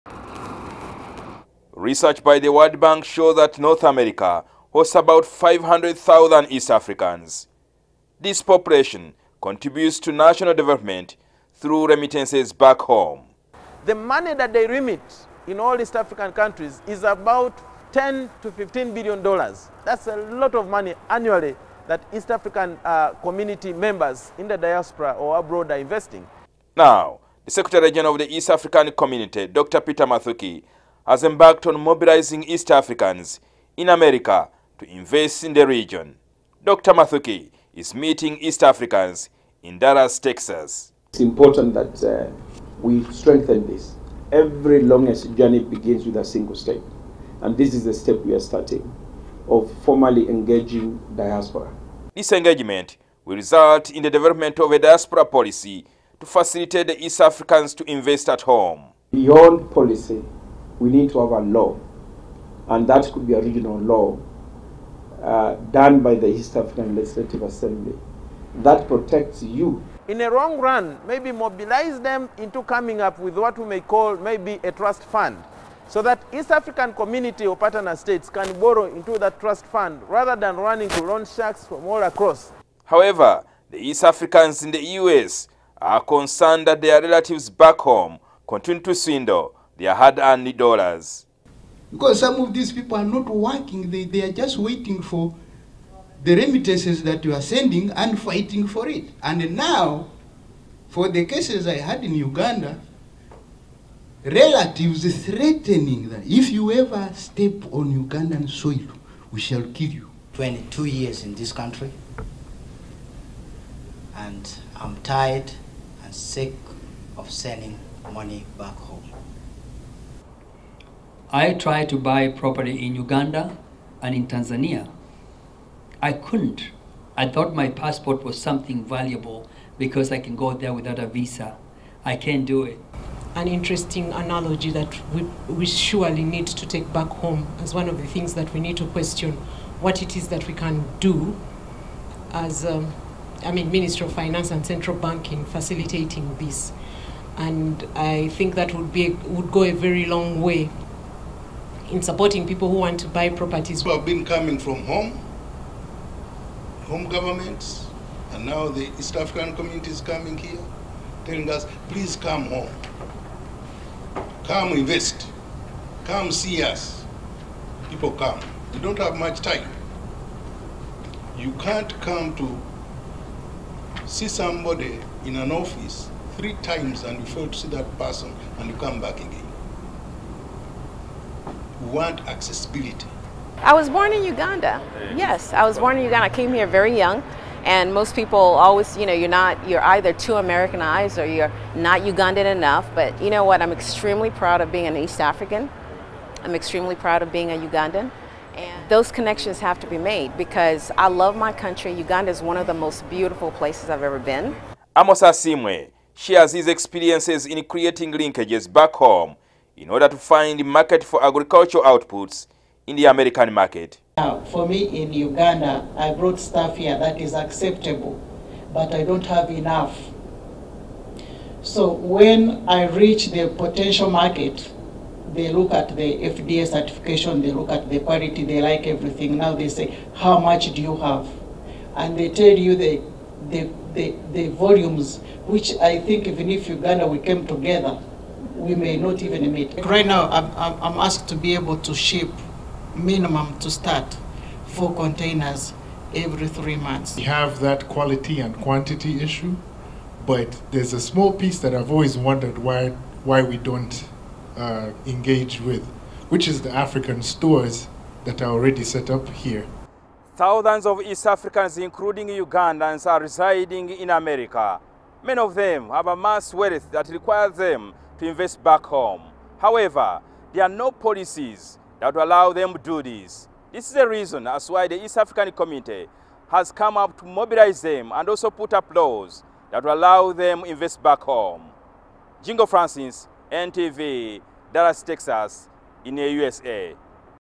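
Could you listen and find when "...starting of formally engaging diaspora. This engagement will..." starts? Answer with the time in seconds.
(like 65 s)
48 s.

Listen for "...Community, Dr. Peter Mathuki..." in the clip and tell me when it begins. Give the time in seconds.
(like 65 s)
28 s.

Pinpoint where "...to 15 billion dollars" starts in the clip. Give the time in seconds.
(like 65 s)
18 s.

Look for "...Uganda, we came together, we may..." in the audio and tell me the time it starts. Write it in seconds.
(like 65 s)
236 s.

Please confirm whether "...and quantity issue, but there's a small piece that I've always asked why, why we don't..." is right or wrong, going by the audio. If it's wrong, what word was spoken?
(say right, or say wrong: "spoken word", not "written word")
wrong: "wondered", not "asked".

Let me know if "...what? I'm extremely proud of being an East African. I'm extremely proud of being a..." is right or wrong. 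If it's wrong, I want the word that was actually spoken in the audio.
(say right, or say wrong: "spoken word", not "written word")
right.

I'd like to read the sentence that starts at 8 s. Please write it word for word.
This population contributes to national development through remittances back home.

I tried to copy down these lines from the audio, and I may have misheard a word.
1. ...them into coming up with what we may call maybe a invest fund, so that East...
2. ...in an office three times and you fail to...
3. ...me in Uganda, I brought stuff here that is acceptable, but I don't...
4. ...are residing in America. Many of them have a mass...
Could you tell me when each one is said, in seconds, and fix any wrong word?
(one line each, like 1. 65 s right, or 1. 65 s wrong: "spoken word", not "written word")
1. 72 s wrong: "trust", not "invest"
2. 175 s right
3. 214 s right
4. 263 s right.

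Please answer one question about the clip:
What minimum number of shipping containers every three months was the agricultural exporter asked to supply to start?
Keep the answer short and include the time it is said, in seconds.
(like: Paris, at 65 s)
4, at 244 s.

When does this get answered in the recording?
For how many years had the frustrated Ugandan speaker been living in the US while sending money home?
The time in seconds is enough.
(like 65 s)
110 s.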